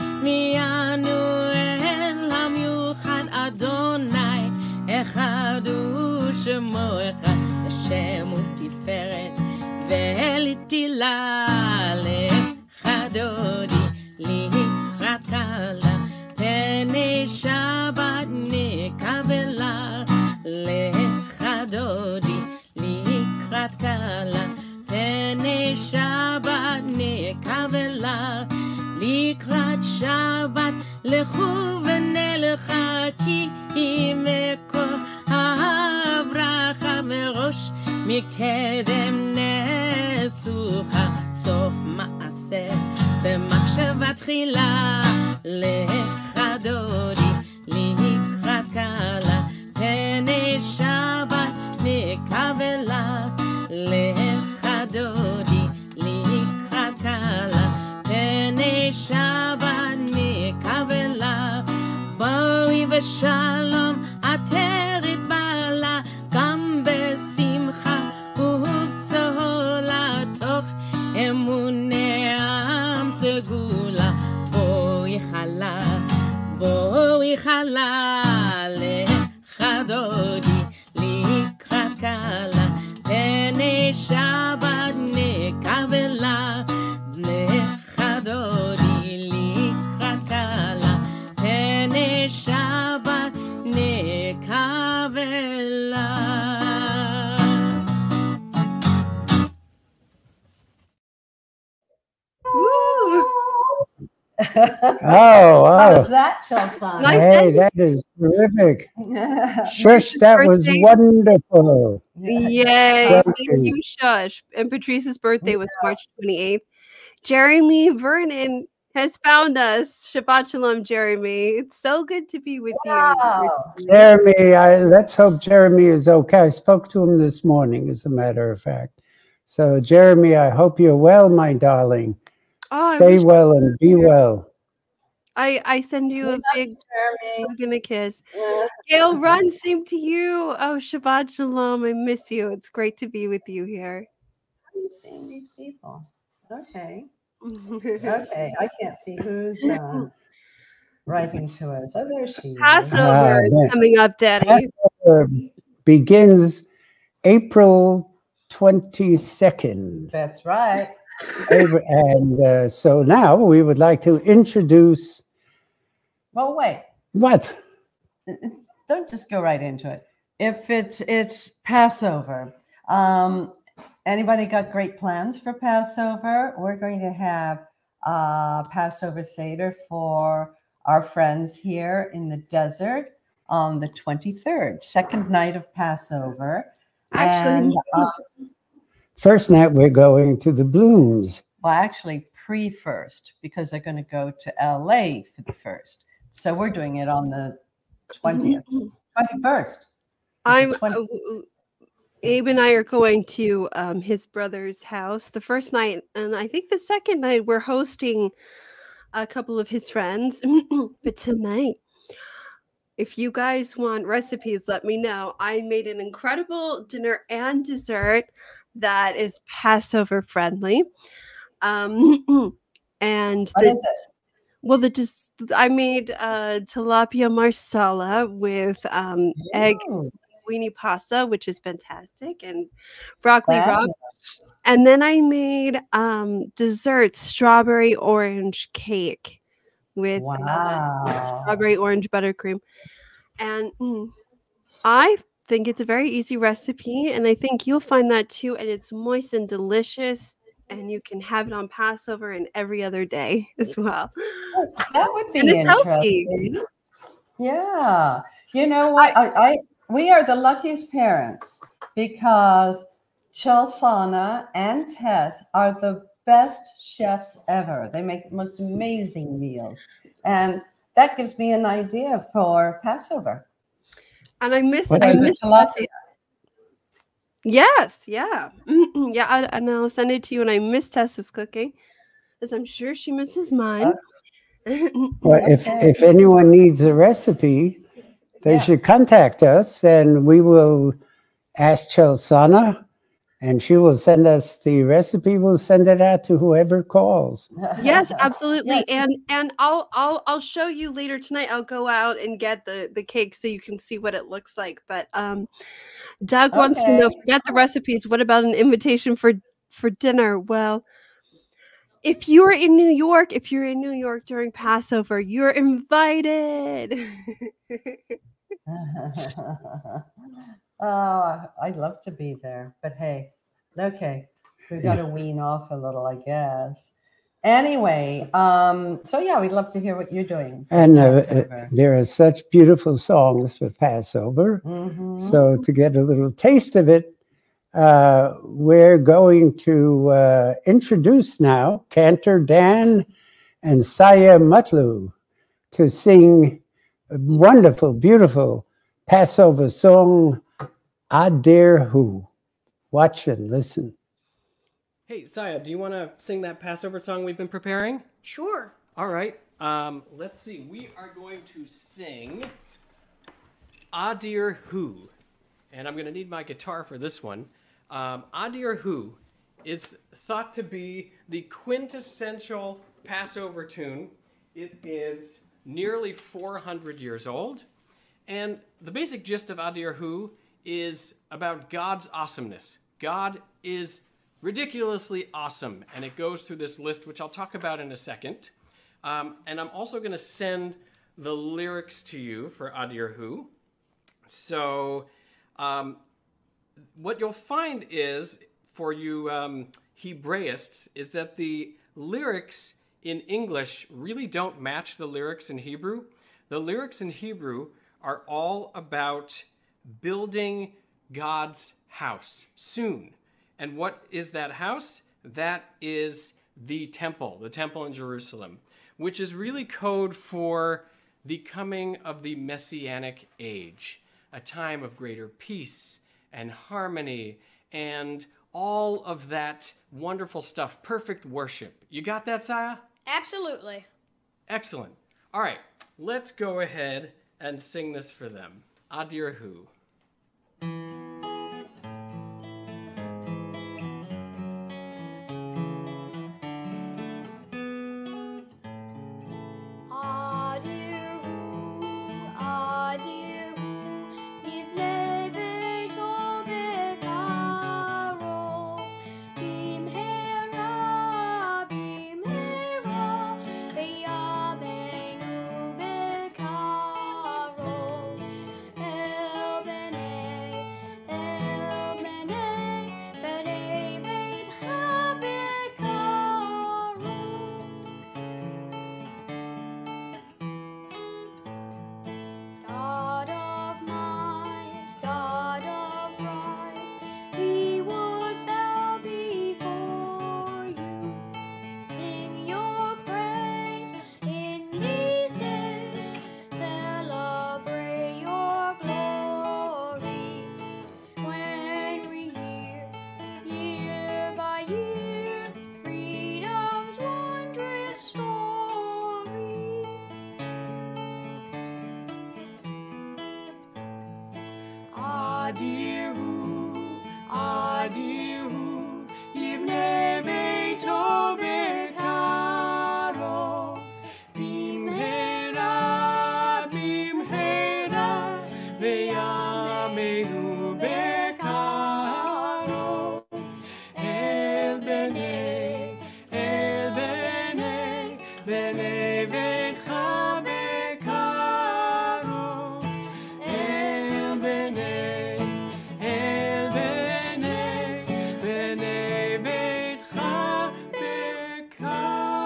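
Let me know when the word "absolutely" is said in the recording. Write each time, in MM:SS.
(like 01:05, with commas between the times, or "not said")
04:58, 07:13.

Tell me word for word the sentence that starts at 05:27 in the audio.
Anyway, um, so yeah, we'd love to hear what you're doing.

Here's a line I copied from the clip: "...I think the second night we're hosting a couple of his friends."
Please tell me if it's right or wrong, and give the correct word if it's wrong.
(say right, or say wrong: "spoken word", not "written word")
right.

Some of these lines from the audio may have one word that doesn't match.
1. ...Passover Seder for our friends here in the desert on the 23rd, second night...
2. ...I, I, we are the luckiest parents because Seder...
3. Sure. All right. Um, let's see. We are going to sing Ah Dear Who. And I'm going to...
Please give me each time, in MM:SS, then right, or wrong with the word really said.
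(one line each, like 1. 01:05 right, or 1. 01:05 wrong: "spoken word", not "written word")
1. 02:58 right
2. 04:19 wrong: "Chelsana", not "Seder"
3. 05:58 right.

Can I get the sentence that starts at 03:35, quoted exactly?
I made an incredible dinner and dessert that is Passover friendly.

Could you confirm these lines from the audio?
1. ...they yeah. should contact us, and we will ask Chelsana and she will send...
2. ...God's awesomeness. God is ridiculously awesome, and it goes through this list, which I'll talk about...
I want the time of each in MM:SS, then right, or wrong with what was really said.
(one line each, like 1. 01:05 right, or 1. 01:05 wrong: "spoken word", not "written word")
1. 04:48 right
2. 06:21 right.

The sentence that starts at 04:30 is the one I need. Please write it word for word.
And that gives me an idea for Passover.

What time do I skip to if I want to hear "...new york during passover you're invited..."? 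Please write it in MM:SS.
05:13.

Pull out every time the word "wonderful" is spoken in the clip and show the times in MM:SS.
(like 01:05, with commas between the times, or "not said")
01:50, 05:47, 07:09.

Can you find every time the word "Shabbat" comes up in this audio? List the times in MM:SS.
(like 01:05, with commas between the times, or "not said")
02:00, 02:20.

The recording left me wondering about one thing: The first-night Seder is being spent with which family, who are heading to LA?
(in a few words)
The Blooms.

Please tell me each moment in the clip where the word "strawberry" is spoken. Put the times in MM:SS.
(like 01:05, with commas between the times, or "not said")
03:57, 04:01.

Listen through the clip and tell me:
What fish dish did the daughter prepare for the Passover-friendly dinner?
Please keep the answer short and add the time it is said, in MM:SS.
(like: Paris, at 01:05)
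Tilapia marsala, at 03:46.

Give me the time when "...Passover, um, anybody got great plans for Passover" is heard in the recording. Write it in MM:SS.
02:51.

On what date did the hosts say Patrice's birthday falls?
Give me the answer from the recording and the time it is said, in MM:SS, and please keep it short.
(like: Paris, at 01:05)
March 28th, at 01:55.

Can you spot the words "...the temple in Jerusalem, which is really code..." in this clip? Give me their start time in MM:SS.
06:57.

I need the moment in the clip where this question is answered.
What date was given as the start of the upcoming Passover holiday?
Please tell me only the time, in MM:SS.
02:37.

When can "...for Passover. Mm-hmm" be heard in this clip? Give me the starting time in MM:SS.
05:33.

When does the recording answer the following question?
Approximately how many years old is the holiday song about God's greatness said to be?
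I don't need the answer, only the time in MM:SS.
06:16.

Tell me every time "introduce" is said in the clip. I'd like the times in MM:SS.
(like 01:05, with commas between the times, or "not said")
02:44, 05:40.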